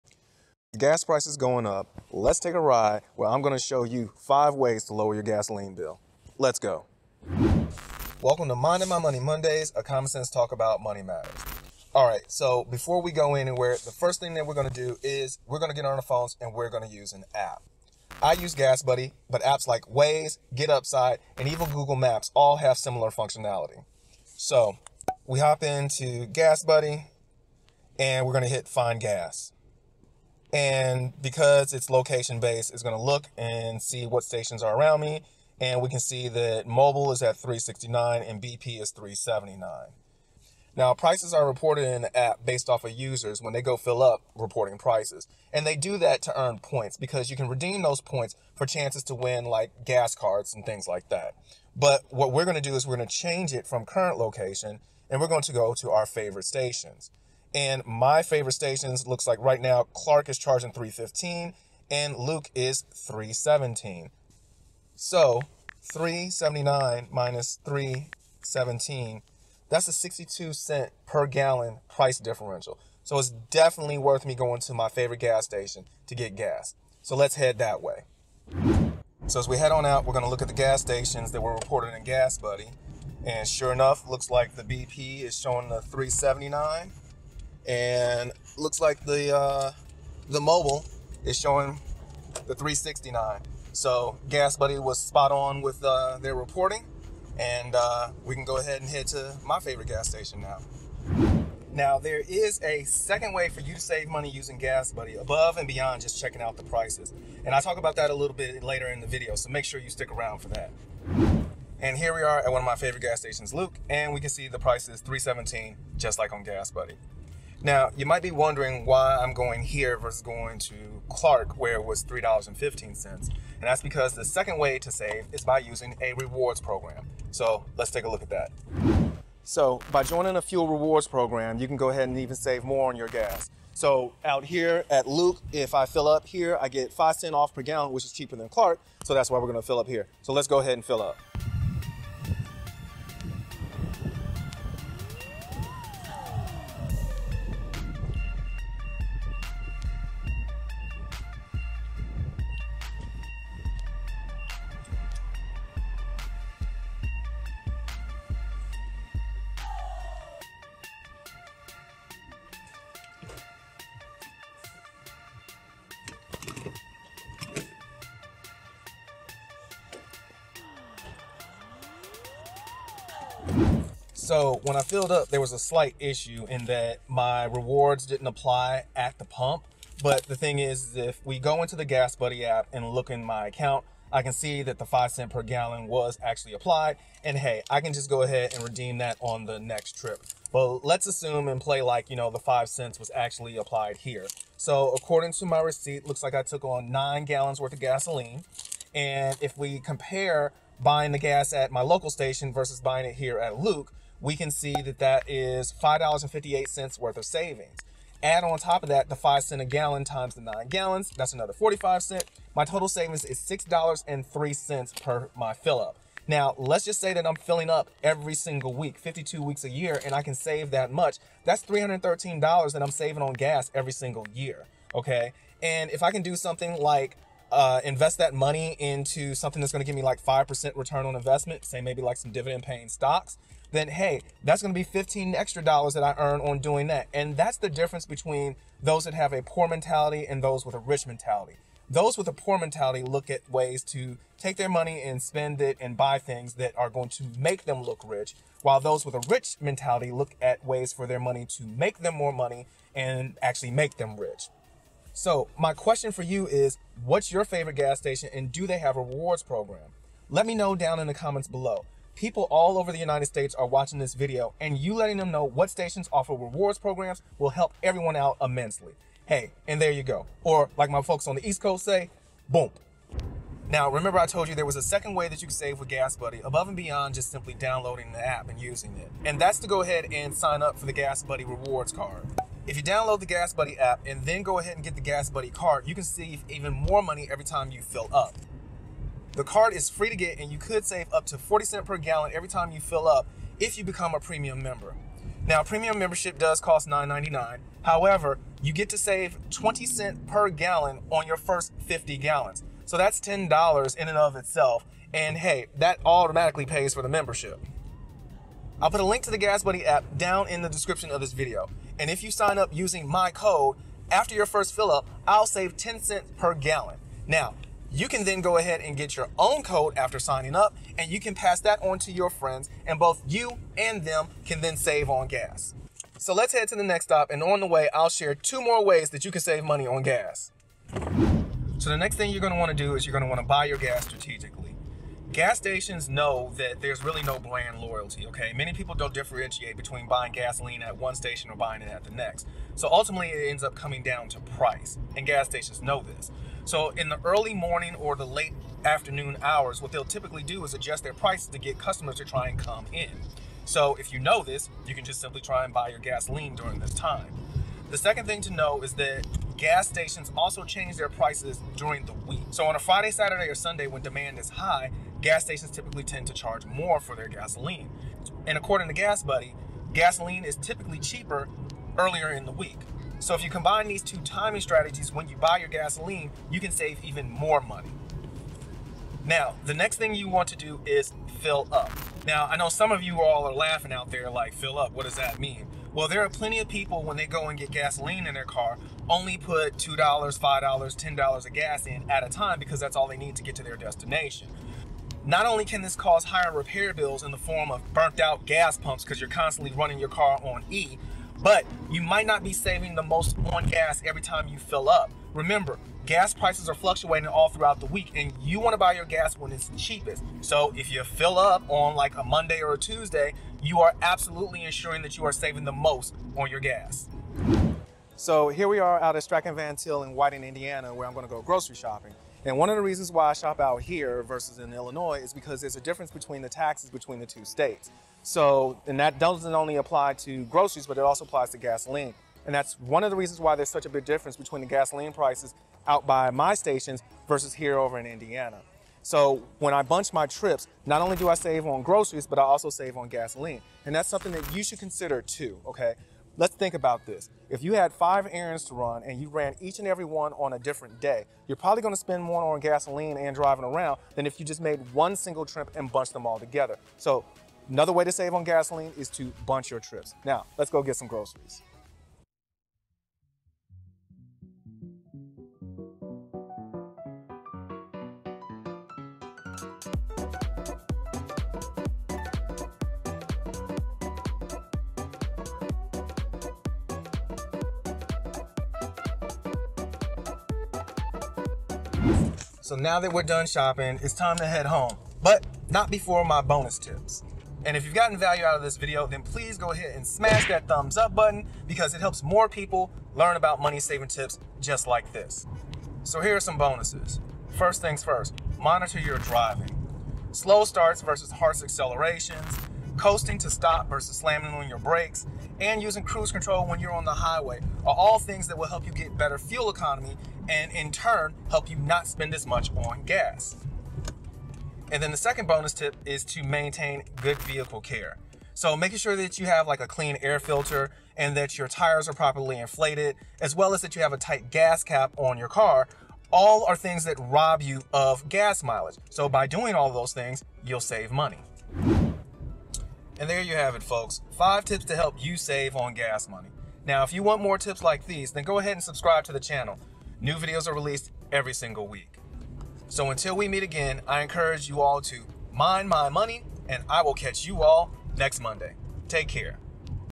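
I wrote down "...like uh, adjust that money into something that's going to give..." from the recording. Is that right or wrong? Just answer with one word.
wrong.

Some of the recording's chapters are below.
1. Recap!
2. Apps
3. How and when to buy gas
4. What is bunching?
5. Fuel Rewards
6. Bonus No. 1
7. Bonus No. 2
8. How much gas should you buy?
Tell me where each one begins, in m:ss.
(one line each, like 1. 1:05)
1. 8:52
2. 0:17
3. 5:31
4. 7:18
5. 2:04
6. 8:16
7. 8:34
8. 6:19.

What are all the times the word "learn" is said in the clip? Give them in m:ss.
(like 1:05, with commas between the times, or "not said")
8:13.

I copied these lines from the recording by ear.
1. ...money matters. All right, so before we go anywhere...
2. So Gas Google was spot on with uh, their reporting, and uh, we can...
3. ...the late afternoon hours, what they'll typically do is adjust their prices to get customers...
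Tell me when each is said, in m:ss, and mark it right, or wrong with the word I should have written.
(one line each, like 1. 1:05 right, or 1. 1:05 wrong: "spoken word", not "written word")
1. 0:10 right
2. 1:33 wrong: "Buddy", not "Google"
3. 5:48 right.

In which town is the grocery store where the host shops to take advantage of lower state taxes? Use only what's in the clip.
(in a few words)
Whiting, Indiana.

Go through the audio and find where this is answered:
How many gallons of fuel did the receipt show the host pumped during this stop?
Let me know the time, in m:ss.
3:16.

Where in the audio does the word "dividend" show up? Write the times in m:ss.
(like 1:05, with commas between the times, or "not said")
3:52.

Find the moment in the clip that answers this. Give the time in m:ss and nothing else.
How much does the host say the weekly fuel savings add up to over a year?
3:41.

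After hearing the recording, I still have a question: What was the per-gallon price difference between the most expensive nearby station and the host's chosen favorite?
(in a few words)
62 cents.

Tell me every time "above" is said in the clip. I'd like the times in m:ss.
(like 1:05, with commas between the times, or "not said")
1:45, 4:36.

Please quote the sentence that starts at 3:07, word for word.
And hey, I can just go ahead and redeem that on the next trip.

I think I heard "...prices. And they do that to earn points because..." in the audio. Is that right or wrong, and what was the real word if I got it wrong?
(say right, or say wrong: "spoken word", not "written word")
right.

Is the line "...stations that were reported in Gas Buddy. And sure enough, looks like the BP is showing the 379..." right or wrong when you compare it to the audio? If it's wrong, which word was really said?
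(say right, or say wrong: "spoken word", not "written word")
right.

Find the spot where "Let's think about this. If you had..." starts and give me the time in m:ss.
7:26.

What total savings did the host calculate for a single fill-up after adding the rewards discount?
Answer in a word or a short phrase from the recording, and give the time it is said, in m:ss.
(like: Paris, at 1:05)
$6.03, at 3:33.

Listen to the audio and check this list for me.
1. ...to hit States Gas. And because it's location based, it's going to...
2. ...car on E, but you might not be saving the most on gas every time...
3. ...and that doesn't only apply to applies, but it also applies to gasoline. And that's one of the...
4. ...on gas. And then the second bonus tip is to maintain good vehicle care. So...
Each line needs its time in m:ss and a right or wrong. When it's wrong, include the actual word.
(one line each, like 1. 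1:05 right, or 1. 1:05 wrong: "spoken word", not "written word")
1. 0:28 wrong: "Find", not "States"
2. 6:40 right
3. 7:08 wrong: "groceries", not "applies"
4. 8:32 right.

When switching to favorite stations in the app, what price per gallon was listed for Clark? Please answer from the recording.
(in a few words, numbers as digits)
$3.15.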